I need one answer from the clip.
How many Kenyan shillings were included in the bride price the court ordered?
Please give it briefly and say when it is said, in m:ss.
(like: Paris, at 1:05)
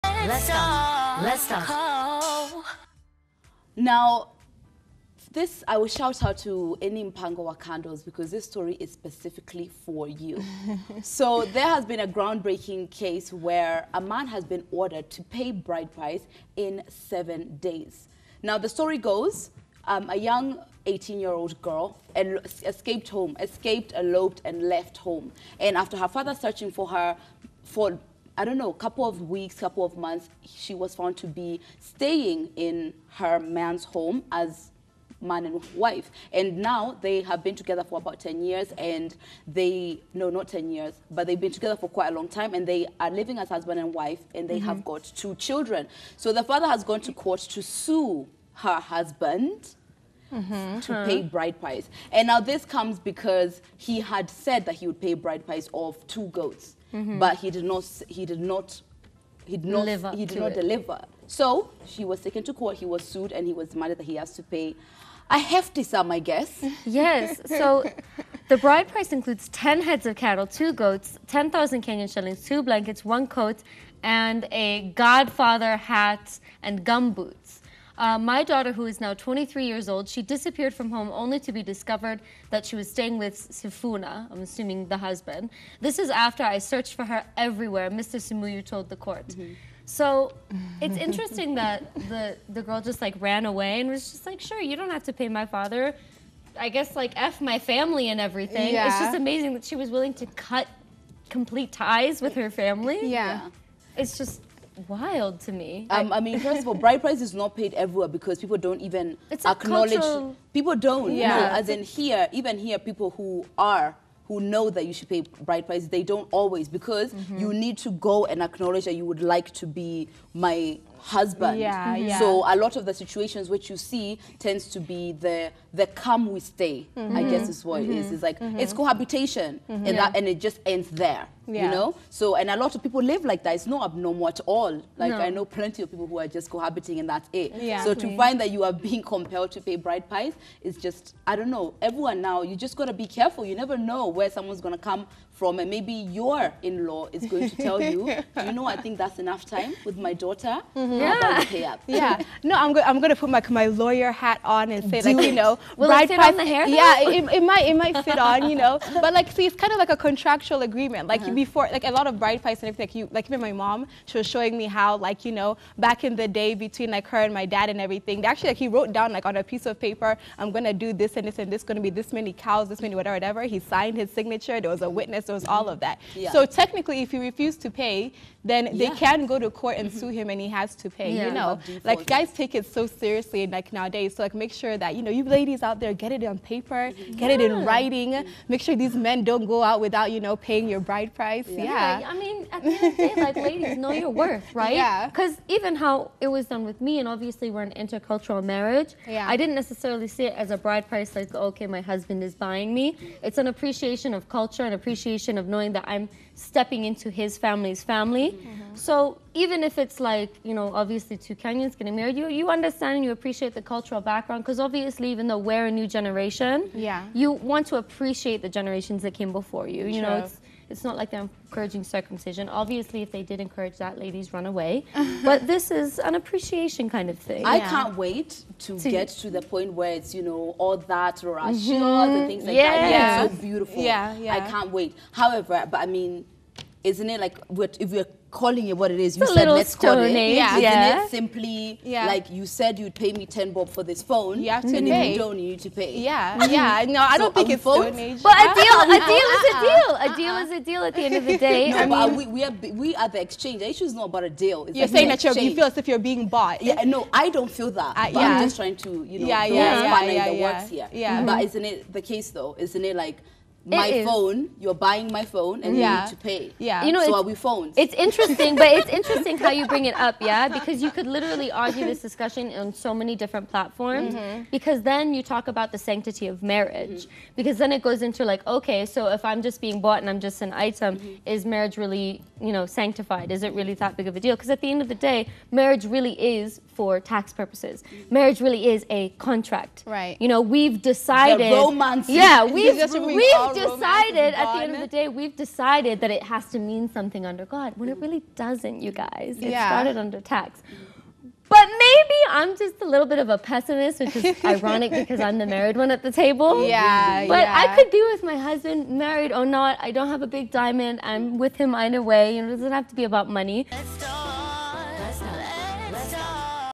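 10,000, at 1:11.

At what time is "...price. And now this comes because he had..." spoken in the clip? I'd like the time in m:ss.
0:51.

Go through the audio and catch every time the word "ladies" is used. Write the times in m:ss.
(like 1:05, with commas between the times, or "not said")
3:05, 3:13, 3:43.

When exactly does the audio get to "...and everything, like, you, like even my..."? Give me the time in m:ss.
2:42.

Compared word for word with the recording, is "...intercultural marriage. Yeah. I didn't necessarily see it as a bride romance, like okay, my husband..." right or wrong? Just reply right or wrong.
wrong.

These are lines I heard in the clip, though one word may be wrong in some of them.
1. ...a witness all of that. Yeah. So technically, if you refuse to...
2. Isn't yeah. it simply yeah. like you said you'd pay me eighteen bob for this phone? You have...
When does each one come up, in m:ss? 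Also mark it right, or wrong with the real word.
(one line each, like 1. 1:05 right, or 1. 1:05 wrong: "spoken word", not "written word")
1. 2:54 right
2. 4:00 wrong: "ten", not "eighteen".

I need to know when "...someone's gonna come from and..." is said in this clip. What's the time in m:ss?
2:24.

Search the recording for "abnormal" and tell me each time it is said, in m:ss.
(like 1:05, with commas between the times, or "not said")
2:13.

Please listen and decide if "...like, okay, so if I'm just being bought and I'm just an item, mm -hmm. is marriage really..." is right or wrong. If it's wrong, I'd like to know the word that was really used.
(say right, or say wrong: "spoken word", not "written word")
right.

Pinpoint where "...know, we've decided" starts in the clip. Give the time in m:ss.
4:50.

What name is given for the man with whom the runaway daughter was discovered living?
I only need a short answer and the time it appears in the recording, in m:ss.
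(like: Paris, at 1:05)
Sifuna, at 1:23.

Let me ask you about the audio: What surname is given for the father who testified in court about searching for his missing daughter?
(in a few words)
Simuyu.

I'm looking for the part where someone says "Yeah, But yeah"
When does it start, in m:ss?
5:06.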